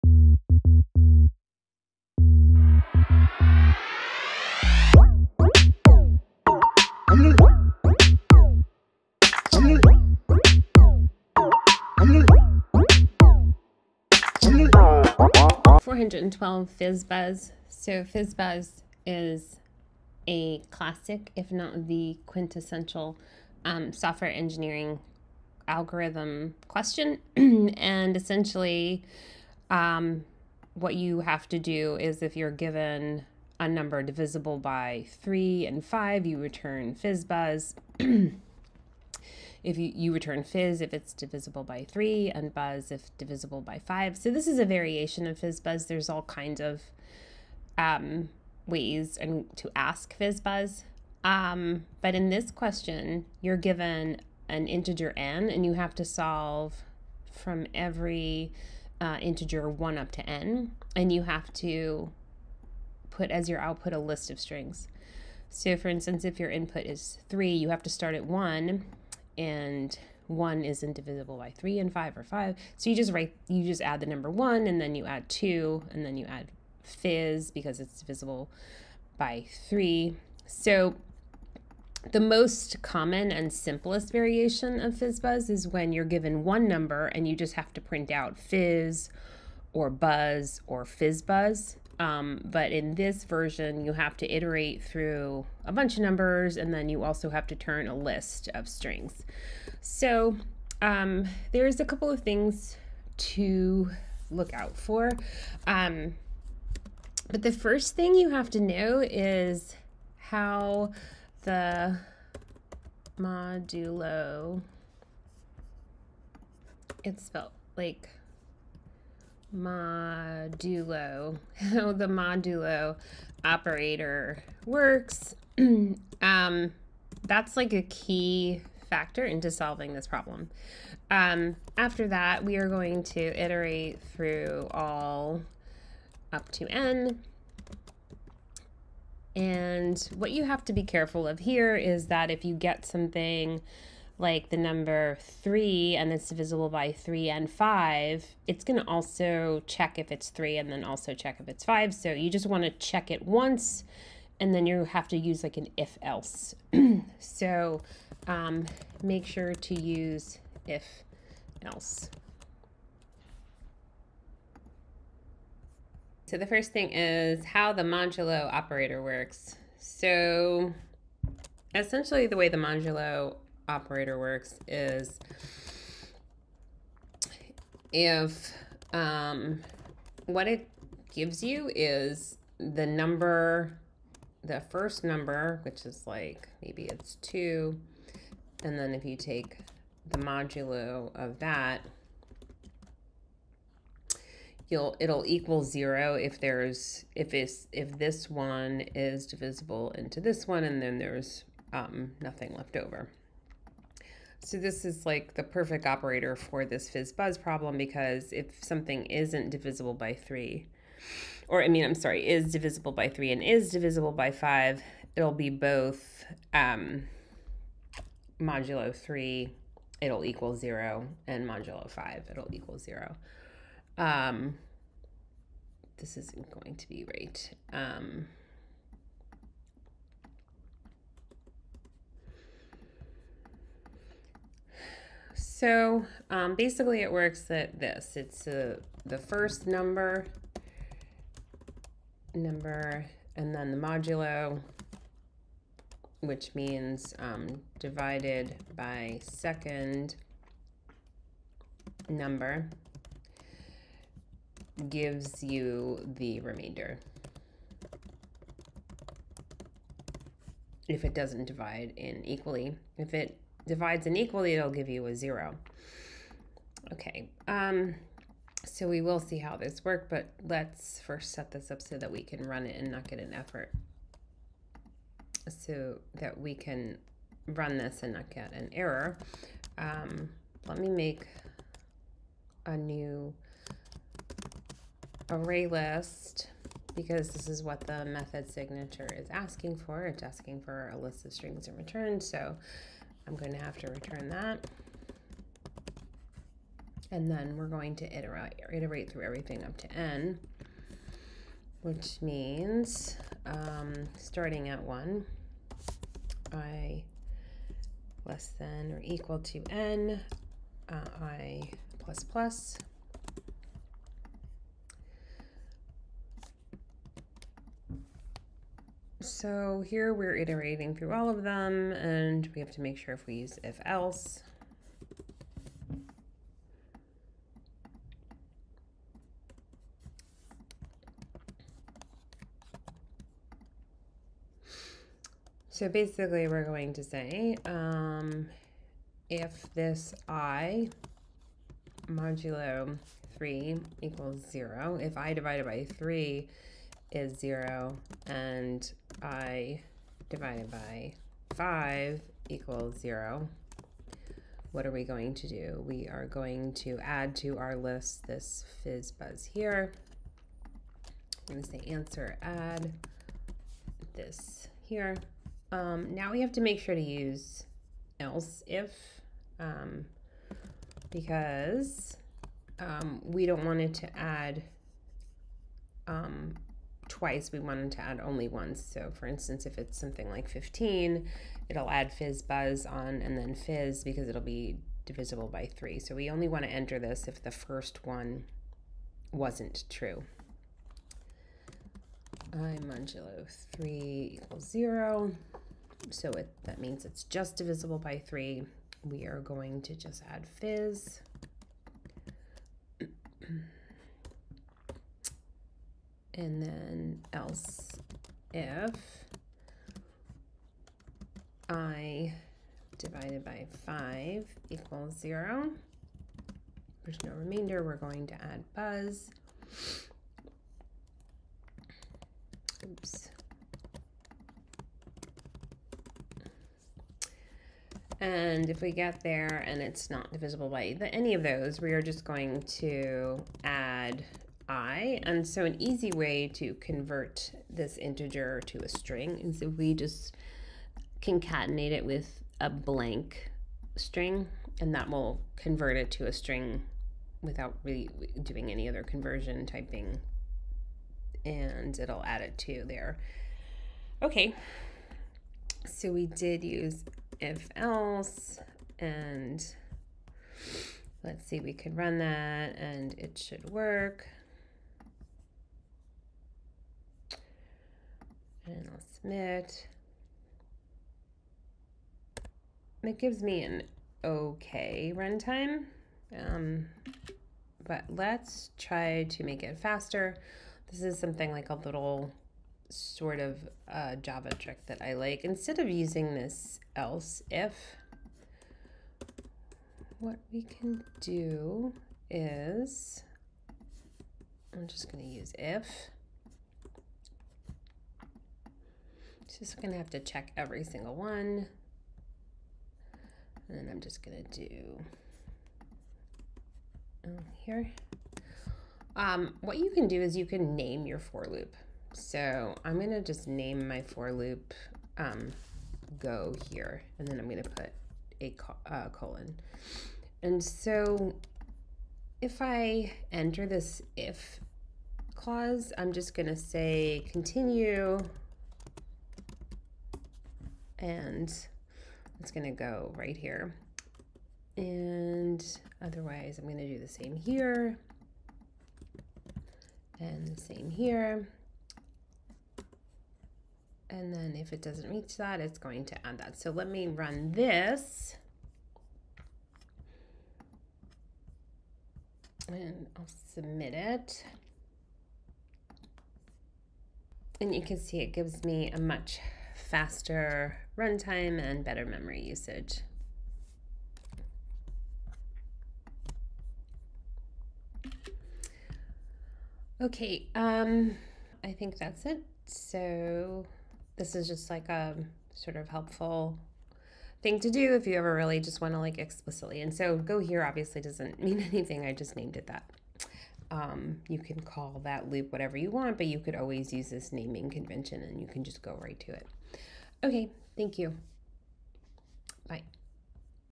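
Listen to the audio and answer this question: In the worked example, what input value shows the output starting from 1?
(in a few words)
3.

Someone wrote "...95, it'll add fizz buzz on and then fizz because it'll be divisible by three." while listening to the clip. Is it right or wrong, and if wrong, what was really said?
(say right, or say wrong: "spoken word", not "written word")
wrong: "15", not "95".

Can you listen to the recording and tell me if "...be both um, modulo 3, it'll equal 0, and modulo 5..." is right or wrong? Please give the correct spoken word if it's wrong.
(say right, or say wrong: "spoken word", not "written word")
right.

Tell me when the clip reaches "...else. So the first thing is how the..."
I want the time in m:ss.
2:41.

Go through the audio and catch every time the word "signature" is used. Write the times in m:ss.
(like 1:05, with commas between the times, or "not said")
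4:48.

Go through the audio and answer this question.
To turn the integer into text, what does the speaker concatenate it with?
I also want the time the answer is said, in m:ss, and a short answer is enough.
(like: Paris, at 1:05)
a blank string, at 7:22.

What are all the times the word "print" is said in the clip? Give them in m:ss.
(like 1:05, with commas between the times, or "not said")
1:27.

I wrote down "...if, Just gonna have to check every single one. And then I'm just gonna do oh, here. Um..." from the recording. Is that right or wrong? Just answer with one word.
right.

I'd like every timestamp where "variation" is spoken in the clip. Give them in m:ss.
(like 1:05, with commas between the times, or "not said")
0:44, 1:24.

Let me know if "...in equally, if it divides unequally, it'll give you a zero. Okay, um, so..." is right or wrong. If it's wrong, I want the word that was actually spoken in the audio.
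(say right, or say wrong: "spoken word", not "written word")
right.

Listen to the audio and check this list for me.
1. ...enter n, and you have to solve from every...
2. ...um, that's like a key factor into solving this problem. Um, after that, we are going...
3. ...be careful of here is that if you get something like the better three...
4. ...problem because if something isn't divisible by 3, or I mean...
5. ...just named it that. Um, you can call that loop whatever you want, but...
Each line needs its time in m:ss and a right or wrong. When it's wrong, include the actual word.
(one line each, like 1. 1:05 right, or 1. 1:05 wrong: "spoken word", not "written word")
1. 0:54 wrong: "integer", not "enter"
2. 2:06 right
3. 2:20 wrong: "number", not "better"
4. 3:27 right
5. 9:42 right.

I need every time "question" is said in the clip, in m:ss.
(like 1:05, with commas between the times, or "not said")
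0:26, 0:52.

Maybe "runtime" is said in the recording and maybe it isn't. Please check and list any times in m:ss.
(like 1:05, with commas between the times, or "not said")
7:55, 9:20.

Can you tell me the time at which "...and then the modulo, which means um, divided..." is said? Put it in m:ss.
4:03.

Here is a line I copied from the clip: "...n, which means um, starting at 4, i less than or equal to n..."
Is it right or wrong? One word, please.
wrong.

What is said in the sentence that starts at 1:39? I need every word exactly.
So um, there's a couple of things to look out for.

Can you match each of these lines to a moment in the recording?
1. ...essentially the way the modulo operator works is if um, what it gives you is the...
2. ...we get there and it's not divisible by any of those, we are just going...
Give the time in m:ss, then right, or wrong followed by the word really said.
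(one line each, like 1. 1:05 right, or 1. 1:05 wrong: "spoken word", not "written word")
1. 2:51 right
2. 7:08 right.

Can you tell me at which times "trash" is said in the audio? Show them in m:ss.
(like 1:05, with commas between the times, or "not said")
not said.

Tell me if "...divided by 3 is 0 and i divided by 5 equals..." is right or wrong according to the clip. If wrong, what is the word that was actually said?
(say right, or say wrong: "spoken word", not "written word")
right.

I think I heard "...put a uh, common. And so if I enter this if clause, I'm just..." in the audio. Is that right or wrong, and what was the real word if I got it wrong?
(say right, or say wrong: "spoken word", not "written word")
wrong: "colon", not "common".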